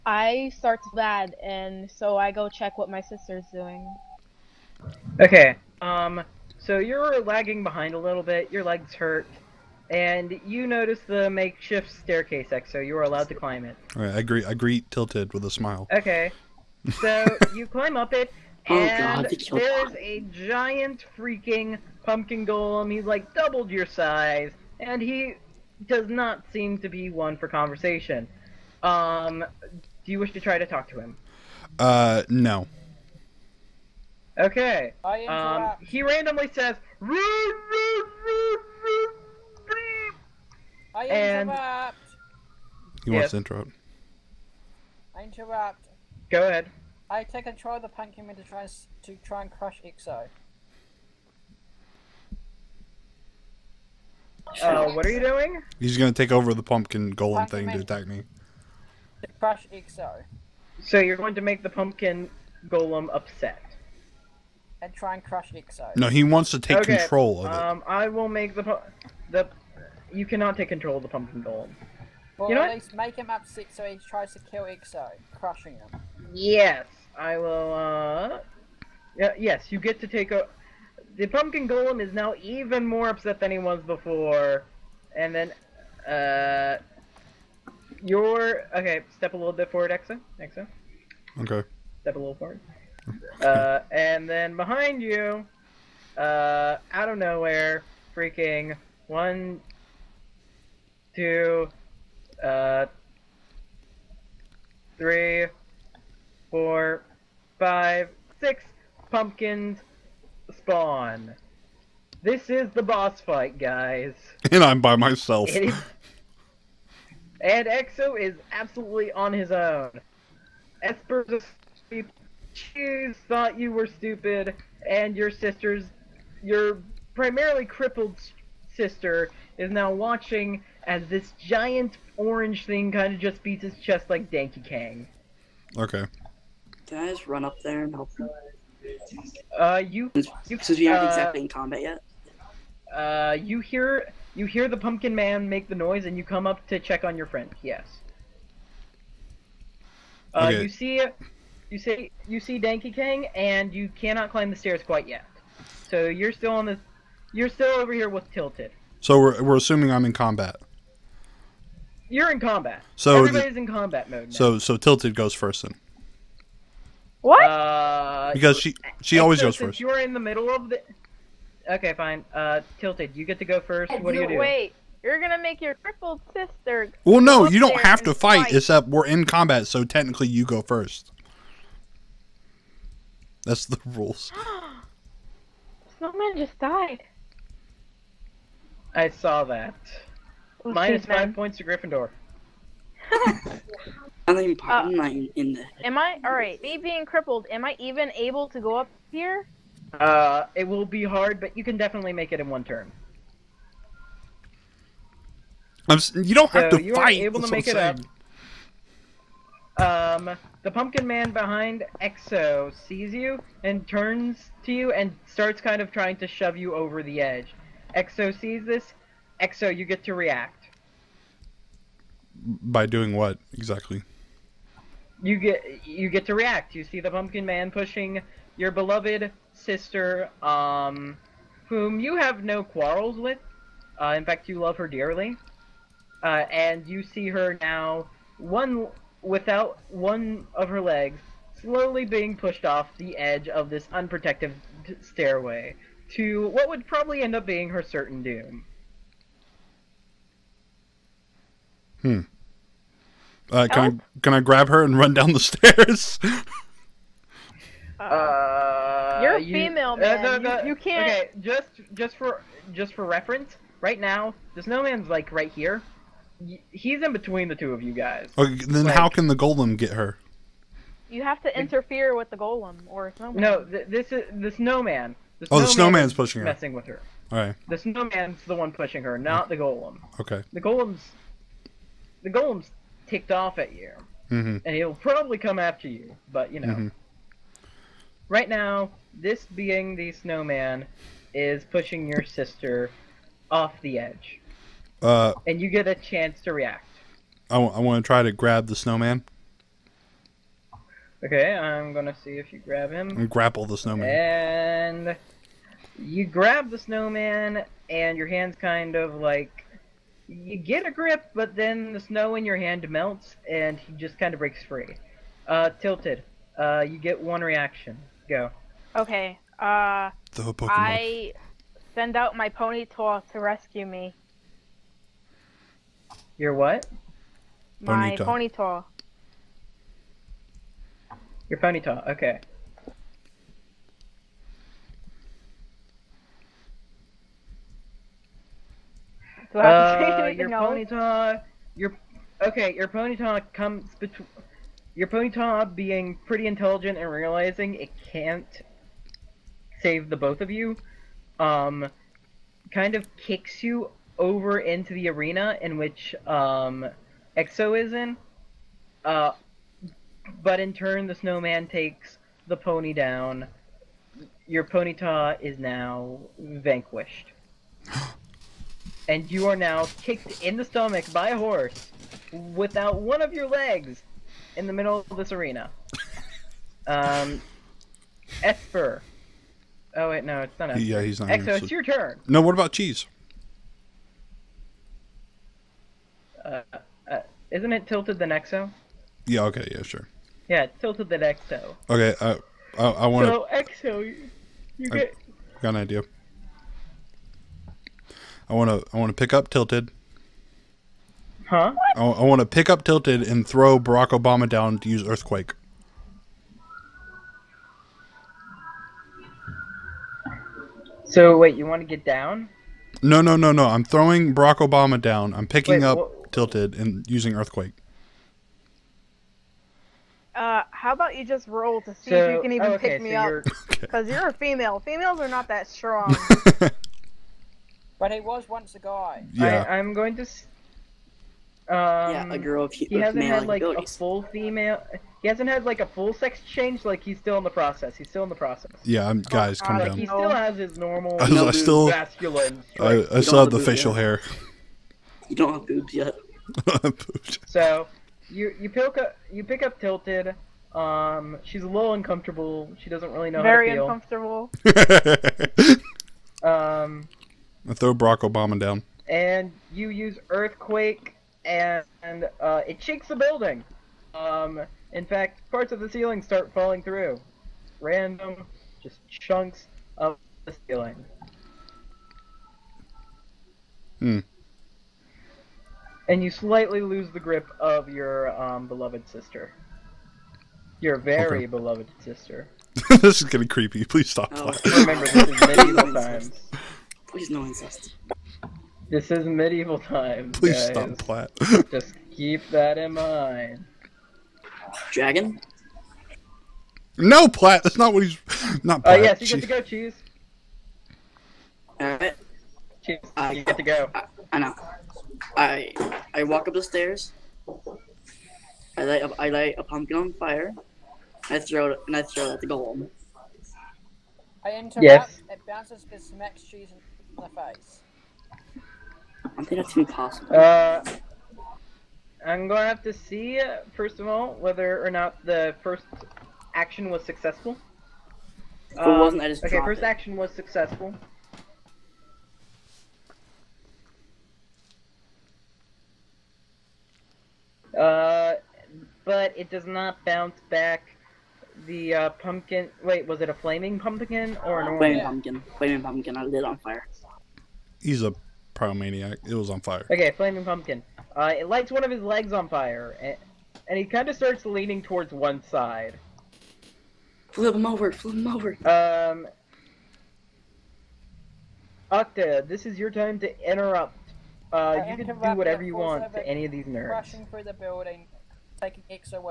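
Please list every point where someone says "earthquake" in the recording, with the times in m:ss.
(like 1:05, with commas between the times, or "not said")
6:45, 6:57, 7:40.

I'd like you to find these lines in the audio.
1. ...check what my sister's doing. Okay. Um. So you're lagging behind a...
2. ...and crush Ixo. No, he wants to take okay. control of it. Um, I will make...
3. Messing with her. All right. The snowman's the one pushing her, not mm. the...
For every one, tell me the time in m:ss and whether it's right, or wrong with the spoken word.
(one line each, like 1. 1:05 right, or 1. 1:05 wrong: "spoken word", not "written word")
1. 0:02 right
2. 1:05 right
3. 4:36 right.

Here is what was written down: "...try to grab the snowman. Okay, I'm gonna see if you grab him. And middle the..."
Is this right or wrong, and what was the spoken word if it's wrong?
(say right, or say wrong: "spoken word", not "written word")
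wrong: "grapple", not "middle".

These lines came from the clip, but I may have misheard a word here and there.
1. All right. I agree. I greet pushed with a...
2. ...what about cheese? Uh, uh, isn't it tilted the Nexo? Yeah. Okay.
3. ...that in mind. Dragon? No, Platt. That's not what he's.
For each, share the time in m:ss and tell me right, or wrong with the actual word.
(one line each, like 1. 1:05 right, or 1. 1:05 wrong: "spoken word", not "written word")
1. 0:13 wrong: "tilted", not "pushed"
2. 6:22 right
3. 8:12 right.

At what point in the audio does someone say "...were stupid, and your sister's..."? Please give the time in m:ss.
2:03.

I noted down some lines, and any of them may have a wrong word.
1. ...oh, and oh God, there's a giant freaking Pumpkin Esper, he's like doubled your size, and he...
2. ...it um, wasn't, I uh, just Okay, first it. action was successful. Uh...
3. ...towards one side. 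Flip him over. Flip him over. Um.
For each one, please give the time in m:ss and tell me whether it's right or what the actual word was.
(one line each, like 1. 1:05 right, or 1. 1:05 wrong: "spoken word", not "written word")
1. 0:18 wrong: "Golem", not "Esper"
2. 8:48 right
3. 9:14 right.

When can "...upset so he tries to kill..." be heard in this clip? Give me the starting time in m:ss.
1:13.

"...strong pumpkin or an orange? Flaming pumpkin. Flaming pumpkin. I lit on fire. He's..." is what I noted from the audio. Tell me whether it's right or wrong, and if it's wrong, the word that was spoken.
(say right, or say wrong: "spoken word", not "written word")
wrong: "flaming", not "strong".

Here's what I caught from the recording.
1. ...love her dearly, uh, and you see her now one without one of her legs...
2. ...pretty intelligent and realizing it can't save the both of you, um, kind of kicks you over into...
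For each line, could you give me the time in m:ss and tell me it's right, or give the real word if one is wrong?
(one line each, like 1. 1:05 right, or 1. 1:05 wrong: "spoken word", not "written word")
1. 3:54 right
2. 5:46 right.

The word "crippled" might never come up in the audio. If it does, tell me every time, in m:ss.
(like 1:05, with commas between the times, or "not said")
2:07, 2:55, 3:17.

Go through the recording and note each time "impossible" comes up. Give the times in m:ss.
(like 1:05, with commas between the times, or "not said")
8:39.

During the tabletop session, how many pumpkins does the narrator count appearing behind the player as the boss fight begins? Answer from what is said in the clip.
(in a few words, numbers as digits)
6.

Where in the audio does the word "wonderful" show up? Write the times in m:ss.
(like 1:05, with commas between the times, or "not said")
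not said.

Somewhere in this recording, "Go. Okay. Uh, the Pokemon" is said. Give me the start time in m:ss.
5:18.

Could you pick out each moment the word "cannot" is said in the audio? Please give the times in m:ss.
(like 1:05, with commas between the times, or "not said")
1:10, 2:34.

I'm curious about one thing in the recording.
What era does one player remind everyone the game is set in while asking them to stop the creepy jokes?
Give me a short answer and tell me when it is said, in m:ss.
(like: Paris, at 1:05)
Medieval times, at 8:09.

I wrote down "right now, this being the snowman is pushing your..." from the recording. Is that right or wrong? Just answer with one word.
right.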